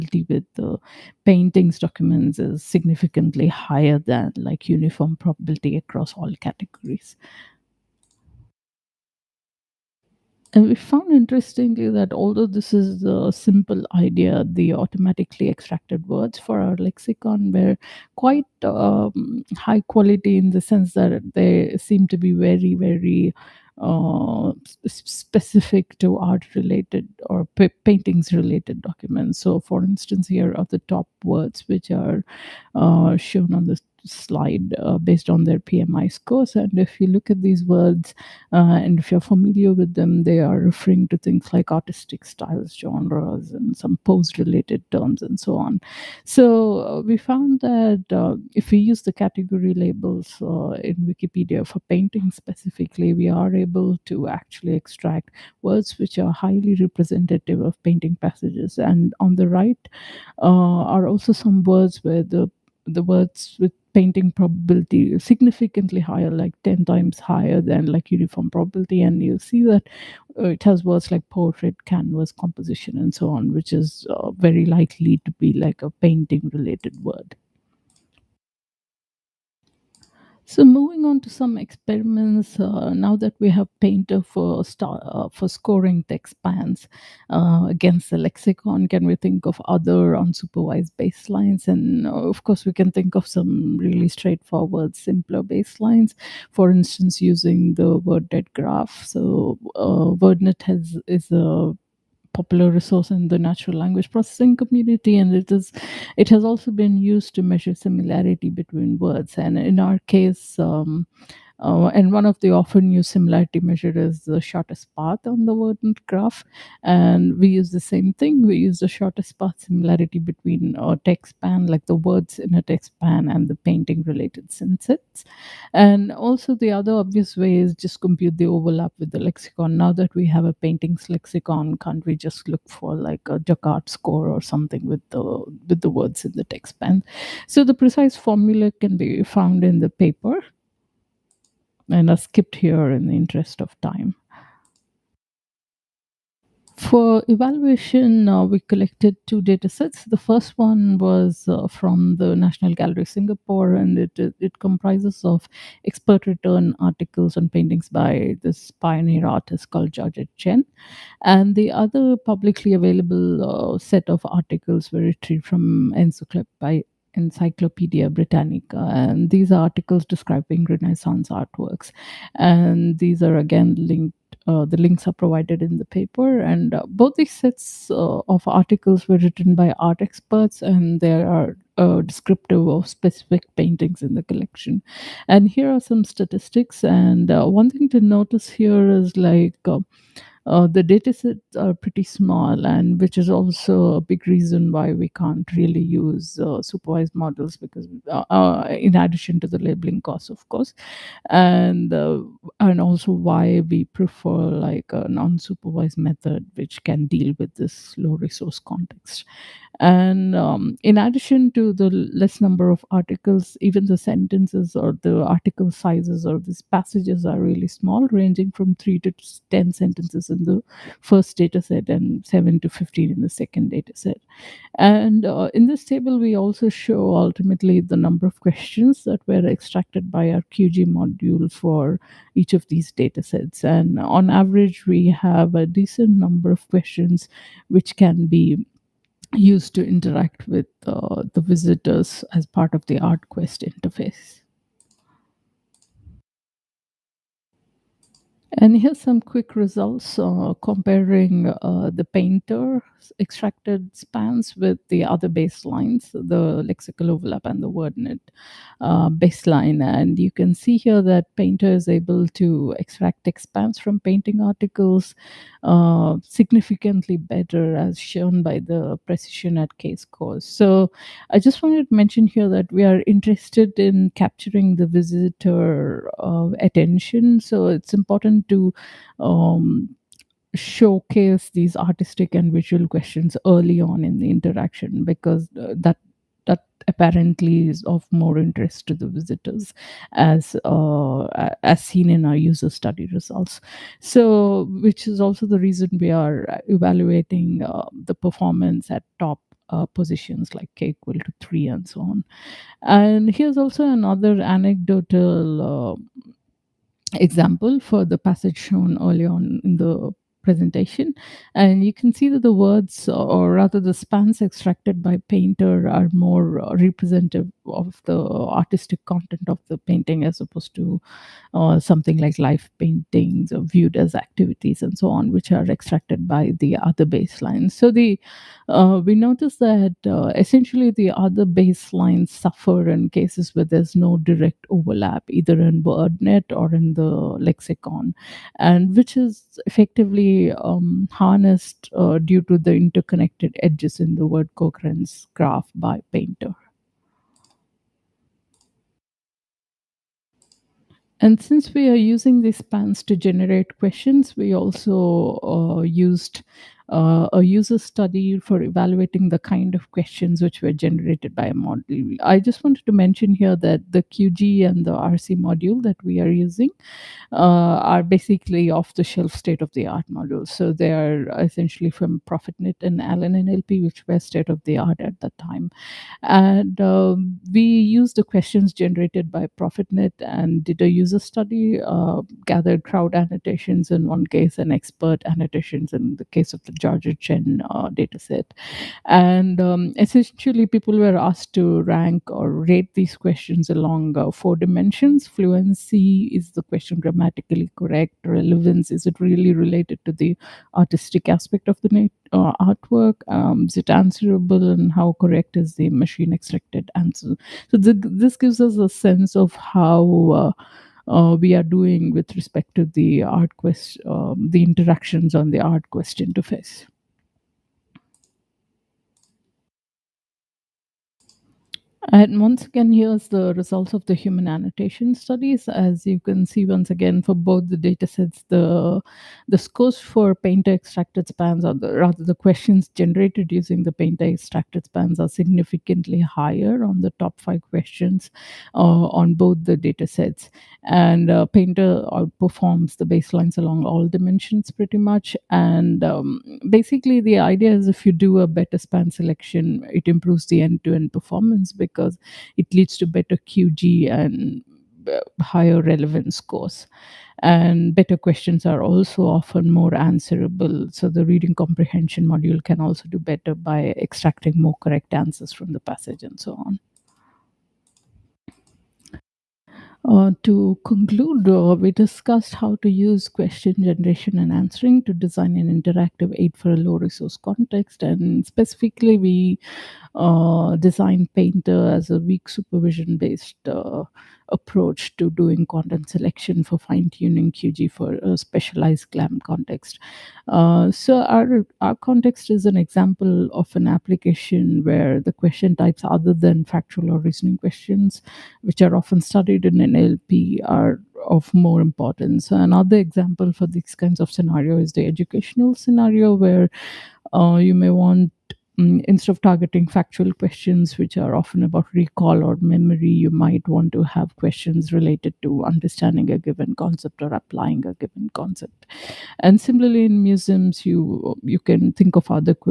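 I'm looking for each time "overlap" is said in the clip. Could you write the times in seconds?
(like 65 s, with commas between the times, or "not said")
128 s, 257 s, 334 s.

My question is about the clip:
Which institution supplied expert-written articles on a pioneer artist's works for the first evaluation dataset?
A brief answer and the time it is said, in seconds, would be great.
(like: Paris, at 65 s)
National Gallery Singapore, at 152 s.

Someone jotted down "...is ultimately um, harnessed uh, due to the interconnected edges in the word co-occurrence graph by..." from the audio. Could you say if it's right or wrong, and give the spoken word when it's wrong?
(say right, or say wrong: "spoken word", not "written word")
wrong: "effectively", not "ultimately".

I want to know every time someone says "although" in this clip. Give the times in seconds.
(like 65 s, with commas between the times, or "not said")
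12 s.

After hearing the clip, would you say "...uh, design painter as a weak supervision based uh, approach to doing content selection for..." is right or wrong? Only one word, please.
right.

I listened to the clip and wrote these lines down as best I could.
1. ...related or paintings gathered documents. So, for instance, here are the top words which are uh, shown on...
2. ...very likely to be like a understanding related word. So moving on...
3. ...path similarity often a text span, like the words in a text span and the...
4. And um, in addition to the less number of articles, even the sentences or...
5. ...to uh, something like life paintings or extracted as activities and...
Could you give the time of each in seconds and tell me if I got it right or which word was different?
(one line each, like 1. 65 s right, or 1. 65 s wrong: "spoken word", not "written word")
1. 26 s wrong: "related", not "gathered"
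2. 74 s wrong: "painting", not "understanding"
3. 119 s wrong: "between", not "often"
4. 209 s right
5. 320 s wrong: "viewed", not "extracted".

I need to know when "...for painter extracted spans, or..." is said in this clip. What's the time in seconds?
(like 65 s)
429 s.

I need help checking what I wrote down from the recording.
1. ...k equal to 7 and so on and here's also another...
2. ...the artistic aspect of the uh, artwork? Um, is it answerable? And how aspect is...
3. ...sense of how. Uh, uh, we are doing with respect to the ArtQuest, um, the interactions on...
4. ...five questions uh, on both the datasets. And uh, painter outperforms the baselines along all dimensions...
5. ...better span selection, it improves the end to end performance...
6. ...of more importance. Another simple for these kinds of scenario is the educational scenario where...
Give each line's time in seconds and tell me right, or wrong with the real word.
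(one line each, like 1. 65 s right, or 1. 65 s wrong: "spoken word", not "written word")
1. 300 s wrong: "3", not "7"
2. 400 s wrong: "correct", not "aspect"
3. 408 s right
4. 437 s right
5. 448 s right
6. 501 s wrong: "example", not "simple".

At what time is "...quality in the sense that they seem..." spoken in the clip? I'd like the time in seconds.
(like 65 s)
19 s.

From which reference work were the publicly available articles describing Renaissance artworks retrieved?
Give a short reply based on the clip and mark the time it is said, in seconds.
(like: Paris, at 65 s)
Encyclopedia Britannica, at 167 s.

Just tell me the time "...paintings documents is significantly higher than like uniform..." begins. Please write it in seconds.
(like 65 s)
1 s.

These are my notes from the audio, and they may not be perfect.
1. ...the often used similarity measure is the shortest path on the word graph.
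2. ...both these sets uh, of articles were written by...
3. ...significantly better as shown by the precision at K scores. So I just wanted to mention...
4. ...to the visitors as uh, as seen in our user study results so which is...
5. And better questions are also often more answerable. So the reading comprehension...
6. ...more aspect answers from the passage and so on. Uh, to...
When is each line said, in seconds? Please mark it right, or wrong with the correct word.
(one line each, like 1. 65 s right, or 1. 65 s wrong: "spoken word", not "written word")
1. 112 s right
2. 176 s right
3. 266 s right
4. 288 s right
5. 457 s right
6. 464 s wrong: "correct", not "aspect".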